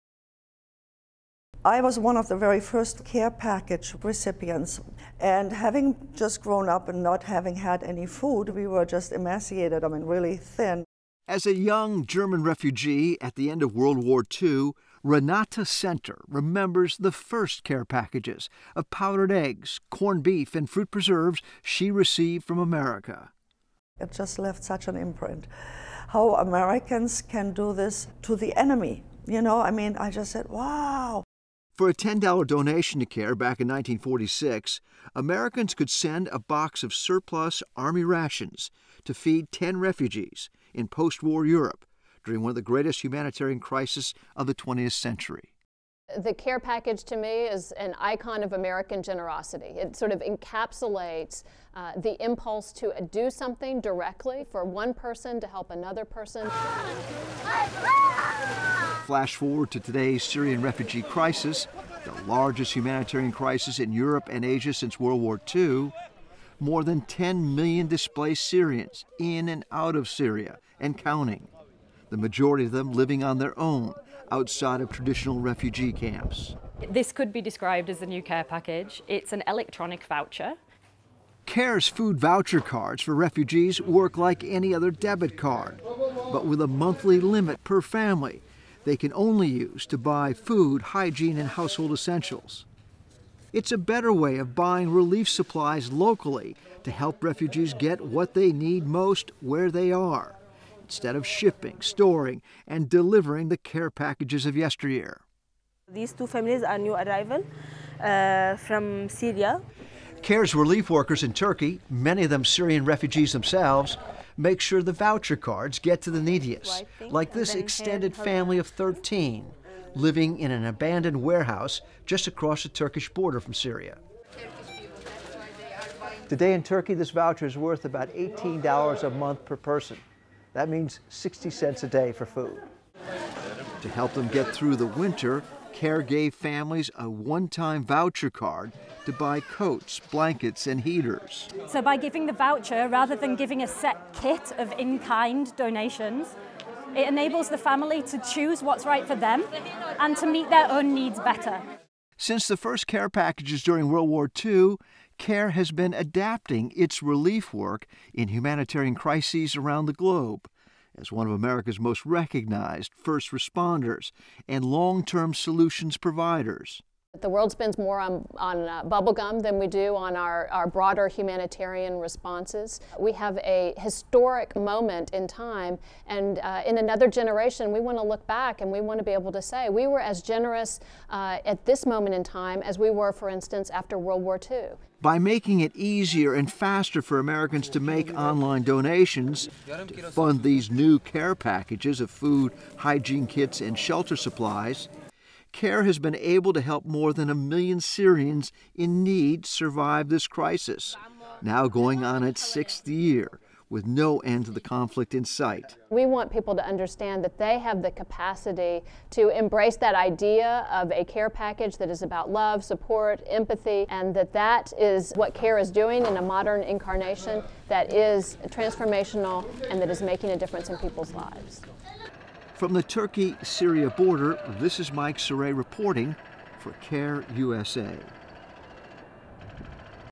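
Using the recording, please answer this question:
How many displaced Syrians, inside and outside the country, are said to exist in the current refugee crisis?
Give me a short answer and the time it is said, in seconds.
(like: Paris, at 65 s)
More than 10 million, at 66 s.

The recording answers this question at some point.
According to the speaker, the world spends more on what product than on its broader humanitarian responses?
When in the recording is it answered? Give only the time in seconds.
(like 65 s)
168 s.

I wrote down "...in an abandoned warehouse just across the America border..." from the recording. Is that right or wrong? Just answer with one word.
wrong.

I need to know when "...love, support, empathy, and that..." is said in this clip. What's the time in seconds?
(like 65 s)
212 s.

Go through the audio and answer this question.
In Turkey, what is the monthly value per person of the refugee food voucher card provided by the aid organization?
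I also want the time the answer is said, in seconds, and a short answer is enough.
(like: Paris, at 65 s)
$18, at 128 s.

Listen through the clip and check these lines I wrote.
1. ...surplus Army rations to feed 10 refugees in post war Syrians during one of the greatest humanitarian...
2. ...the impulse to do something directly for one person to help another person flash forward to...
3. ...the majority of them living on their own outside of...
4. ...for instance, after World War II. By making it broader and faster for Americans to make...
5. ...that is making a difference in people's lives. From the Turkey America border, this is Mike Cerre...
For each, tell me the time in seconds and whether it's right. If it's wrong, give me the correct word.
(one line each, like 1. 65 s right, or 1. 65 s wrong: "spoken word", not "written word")
1. 36 s wrong: "Europe", not "Syrians"
2. 51 s right
3. 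72 s right
4. 183 s wrong: "easier", not "broader"
5. 219 s wrong: "Syria", not "America".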